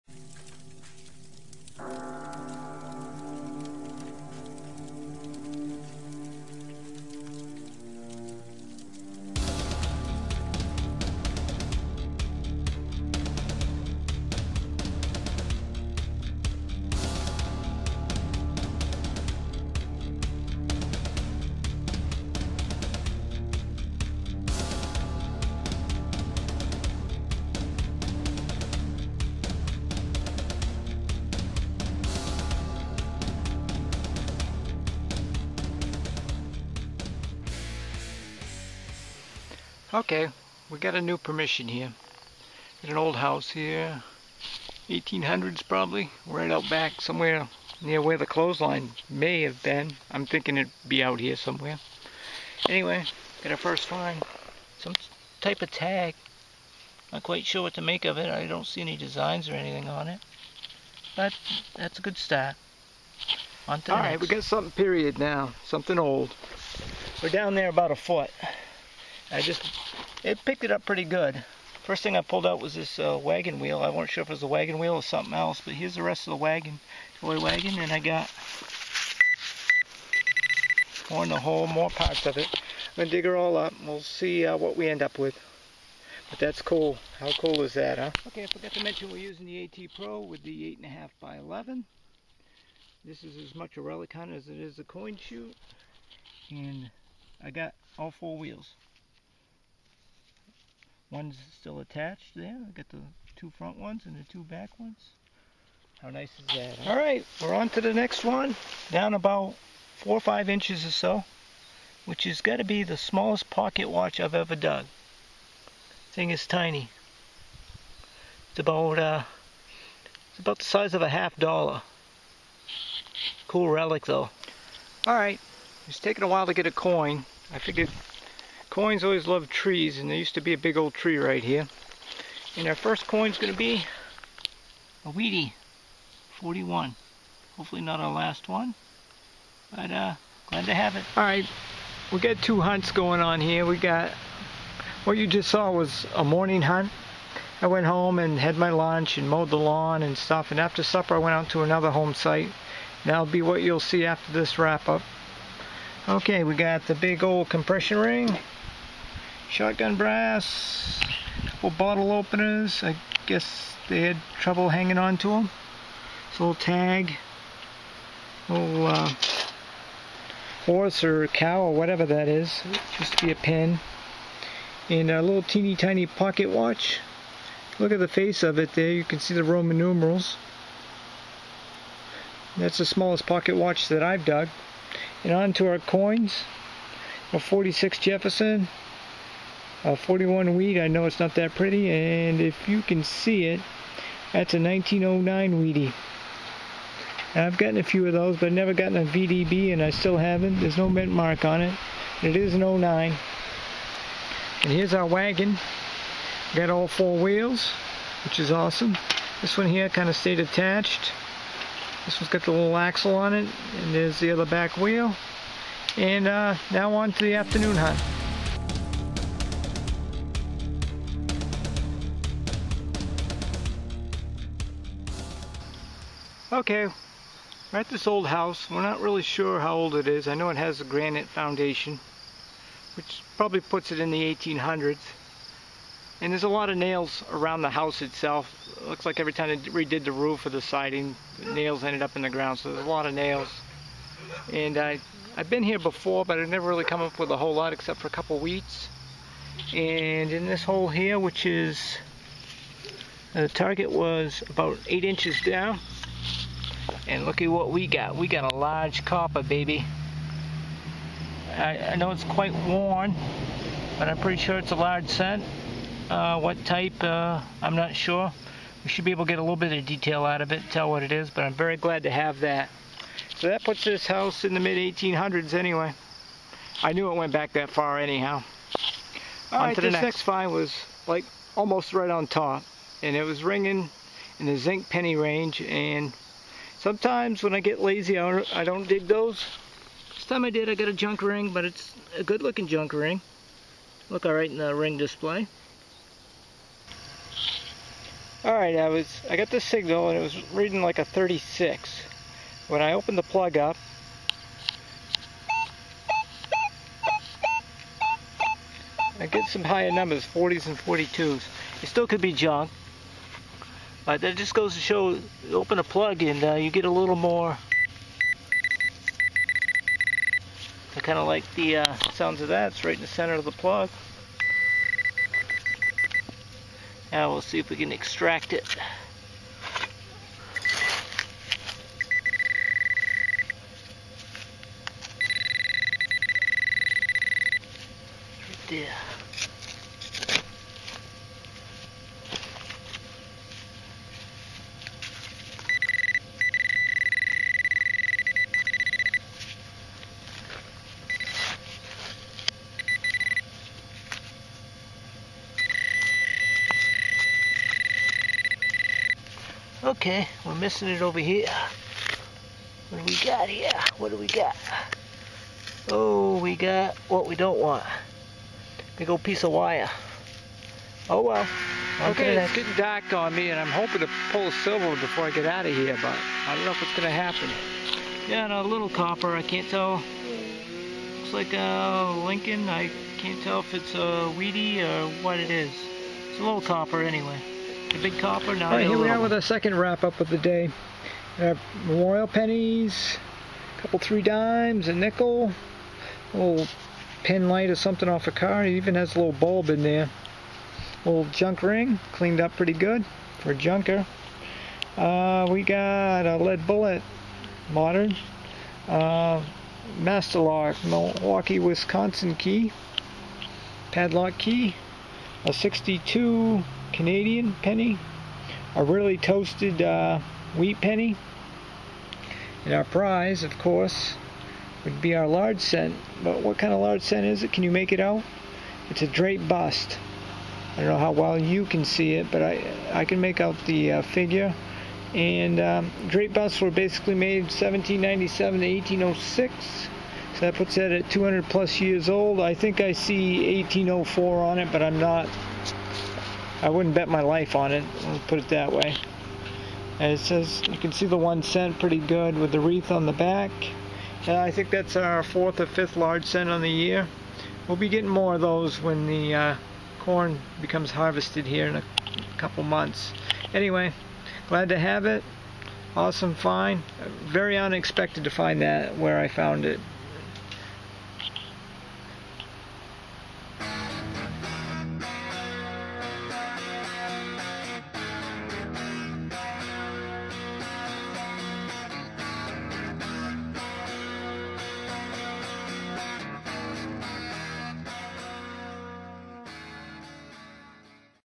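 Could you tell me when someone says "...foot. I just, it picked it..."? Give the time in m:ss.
1:07.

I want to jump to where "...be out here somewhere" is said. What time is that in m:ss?
0:50.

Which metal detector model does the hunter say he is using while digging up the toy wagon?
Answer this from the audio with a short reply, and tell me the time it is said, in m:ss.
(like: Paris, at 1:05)
AT Pro, at 1:29.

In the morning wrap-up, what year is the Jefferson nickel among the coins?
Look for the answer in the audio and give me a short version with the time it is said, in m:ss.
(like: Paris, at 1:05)
1946, at 3:07.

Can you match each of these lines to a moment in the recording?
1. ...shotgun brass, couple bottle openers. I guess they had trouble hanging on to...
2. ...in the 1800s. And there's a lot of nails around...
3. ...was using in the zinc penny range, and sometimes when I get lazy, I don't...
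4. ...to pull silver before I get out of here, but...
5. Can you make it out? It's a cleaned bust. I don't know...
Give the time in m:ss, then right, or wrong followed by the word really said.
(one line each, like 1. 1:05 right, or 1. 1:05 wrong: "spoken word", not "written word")
1. 2:39 right
2. 3:53 right
3. 4:43 wrong: "ringing", not "using"
4. 6:13 right
5. 7:07 wrong: "draped", not "cleaned".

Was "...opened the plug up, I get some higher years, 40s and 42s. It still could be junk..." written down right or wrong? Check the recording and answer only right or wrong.
wrong.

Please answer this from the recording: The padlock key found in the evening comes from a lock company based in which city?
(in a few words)
Milwaukee.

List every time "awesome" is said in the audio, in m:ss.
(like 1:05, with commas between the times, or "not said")
3:28, 7:45.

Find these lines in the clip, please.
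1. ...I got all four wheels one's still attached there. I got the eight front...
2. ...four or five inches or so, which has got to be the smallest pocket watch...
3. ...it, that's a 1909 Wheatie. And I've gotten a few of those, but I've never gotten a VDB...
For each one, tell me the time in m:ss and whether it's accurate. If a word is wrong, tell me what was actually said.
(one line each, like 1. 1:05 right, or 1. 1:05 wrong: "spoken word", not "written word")
1. 1:37 wrong: "two", not "eight"
2. 1:49 right
3. 3:13 right.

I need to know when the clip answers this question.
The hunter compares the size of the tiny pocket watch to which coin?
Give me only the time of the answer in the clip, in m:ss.
2:01.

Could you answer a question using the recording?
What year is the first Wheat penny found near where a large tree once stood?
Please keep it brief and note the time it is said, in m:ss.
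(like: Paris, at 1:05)
1941, at 2:15.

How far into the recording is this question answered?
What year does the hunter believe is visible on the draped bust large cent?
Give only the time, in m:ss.
7:23.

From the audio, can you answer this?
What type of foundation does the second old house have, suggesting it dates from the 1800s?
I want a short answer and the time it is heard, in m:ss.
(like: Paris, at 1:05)
granite, at 3:50.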